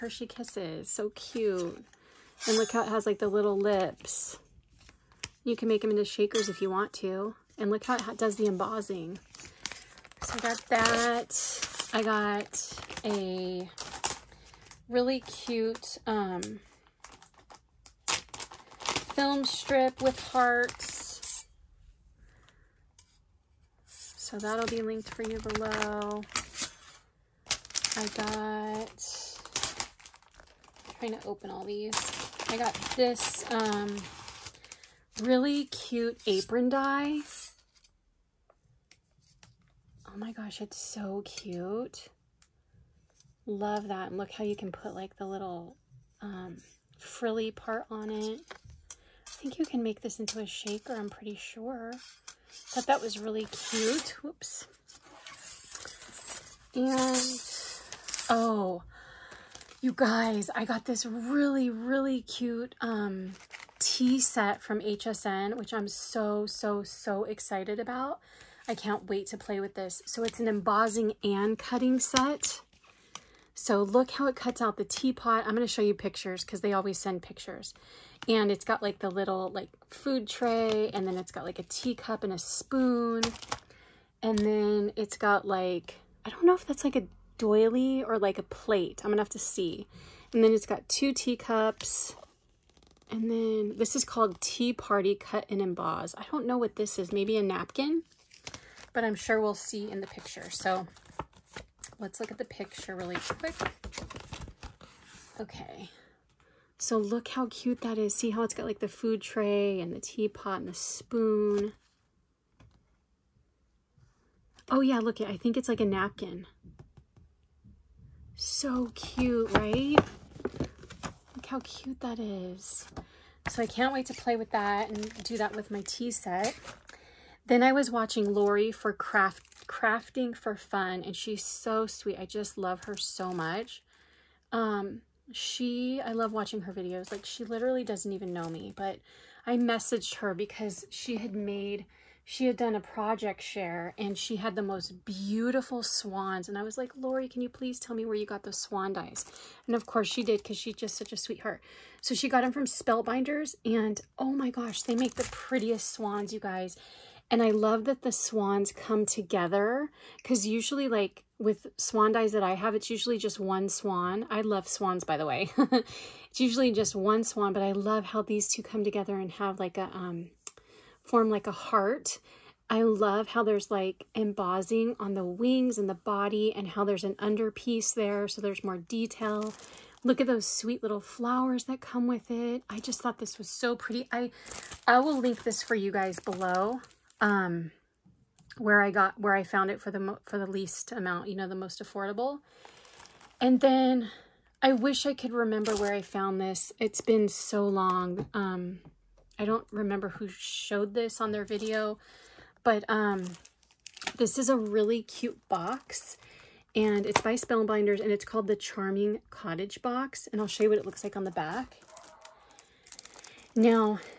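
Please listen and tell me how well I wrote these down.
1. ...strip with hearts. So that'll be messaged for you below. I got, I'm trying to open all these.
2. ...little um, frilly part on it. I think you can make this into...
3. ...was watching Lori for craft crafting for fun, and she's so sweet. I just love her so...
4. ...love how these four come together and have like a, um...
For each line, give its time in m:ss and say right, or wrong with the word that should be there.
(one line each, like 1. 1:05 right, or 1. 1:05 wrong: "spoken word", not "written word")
1. 0:19 wrong: "linked", not "messaged"
2. 0:45 right
3. 2:07 right
4. 2:47 wrong: "two", not "four".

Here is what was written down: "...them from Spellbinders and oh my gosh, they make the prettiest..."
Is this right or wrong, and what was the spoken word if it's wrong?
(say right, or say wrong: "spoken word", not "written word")
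right.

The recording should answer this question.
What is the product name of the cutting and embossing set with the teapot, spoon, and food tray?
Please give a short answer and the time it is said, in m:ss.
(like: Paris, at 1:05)
Tea Party Cut and Emboss, at 1:34.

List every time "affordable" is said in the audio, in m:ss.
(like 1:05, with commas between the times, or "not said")
3:11.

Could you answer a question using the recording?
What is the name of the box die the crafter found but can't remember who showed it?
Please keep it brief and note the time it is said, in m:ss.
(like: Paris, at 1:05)
Charming Cottage Box, at 3:28.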